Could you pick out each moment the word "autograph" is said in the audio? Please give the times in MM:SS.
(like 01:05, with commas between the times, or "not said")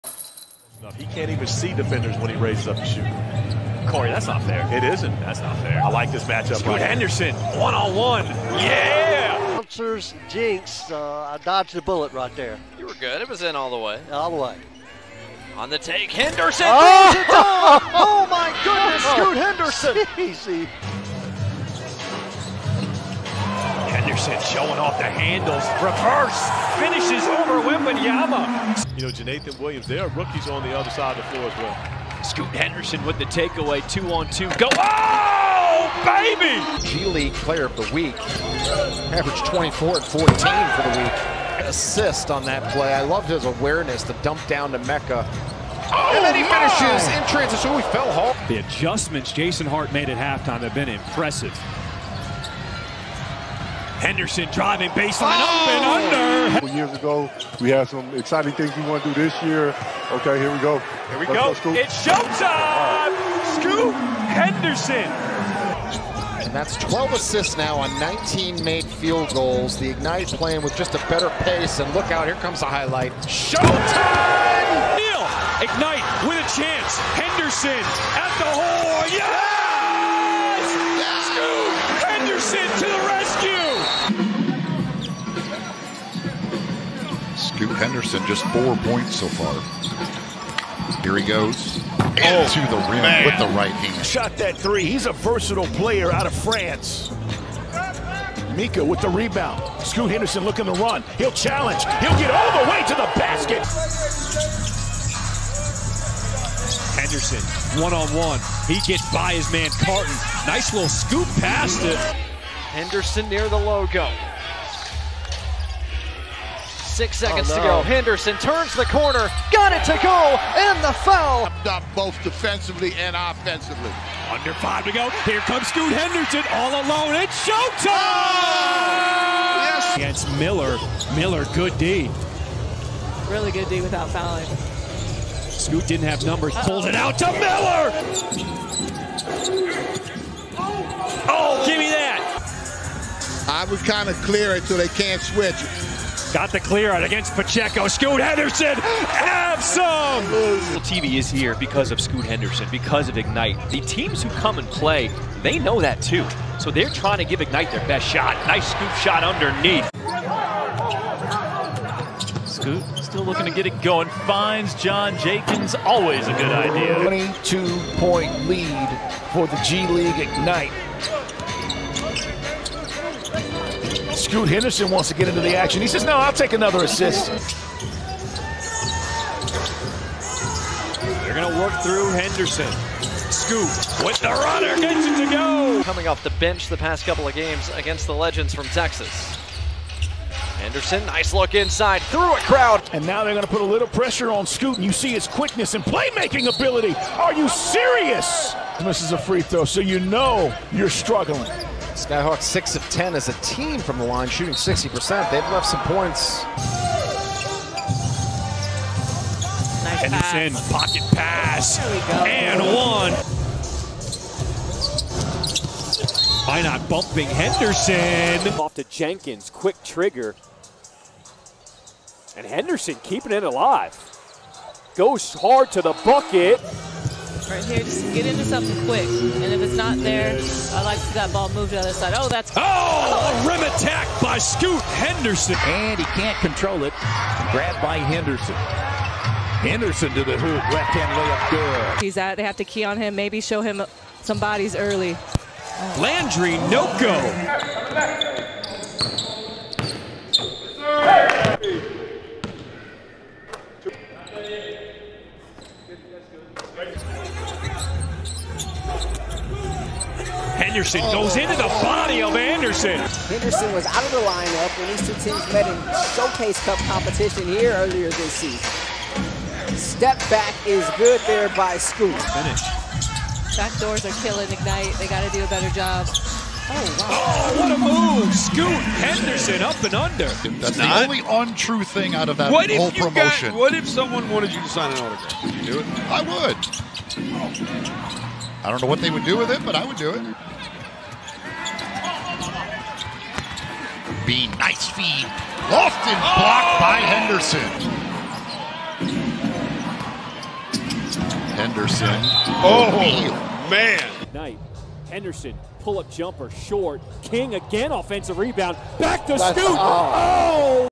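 04:45.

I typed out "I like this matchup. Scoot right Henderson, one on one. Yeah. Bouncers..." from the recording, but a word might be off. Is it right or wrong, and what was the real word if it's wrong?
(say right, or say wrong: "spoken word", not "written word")
right.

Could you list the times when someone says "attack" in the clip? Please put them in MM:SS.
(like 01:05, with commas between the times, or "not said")
03:53.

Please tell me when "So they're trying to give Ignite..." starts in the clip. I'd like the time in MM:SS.
02:36.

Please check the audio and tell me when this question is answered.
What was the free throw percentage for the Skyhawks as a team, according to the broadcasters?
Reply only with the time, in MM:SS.
03:24.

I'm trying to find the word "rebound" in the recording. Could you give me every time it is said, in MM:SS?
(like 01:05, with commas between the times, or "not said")
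01:39, 05:08.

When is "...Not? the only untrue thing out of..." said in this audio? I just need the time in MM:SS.
04:40.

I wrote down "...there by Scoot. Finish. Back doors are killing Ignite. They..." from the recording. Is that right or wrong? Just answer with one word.
right.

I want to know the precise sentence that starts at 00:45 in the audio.
Oh, and then he oh, finishes in transition.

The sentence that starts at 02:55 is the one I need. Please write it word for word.
He says, no, I'll take another assist.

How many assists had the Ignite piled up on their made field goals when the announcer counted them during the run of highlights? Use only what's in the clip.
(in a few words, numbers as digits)
12.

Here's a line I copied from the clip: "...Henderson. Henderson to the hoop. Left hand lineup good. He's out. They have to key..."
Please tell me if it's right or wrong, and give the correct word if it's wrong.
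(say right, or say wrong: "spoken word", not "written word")
wrong: "layup", not "lineup".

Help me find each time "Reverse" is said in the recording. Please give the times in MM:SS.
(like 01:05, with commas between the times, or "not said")
00:25.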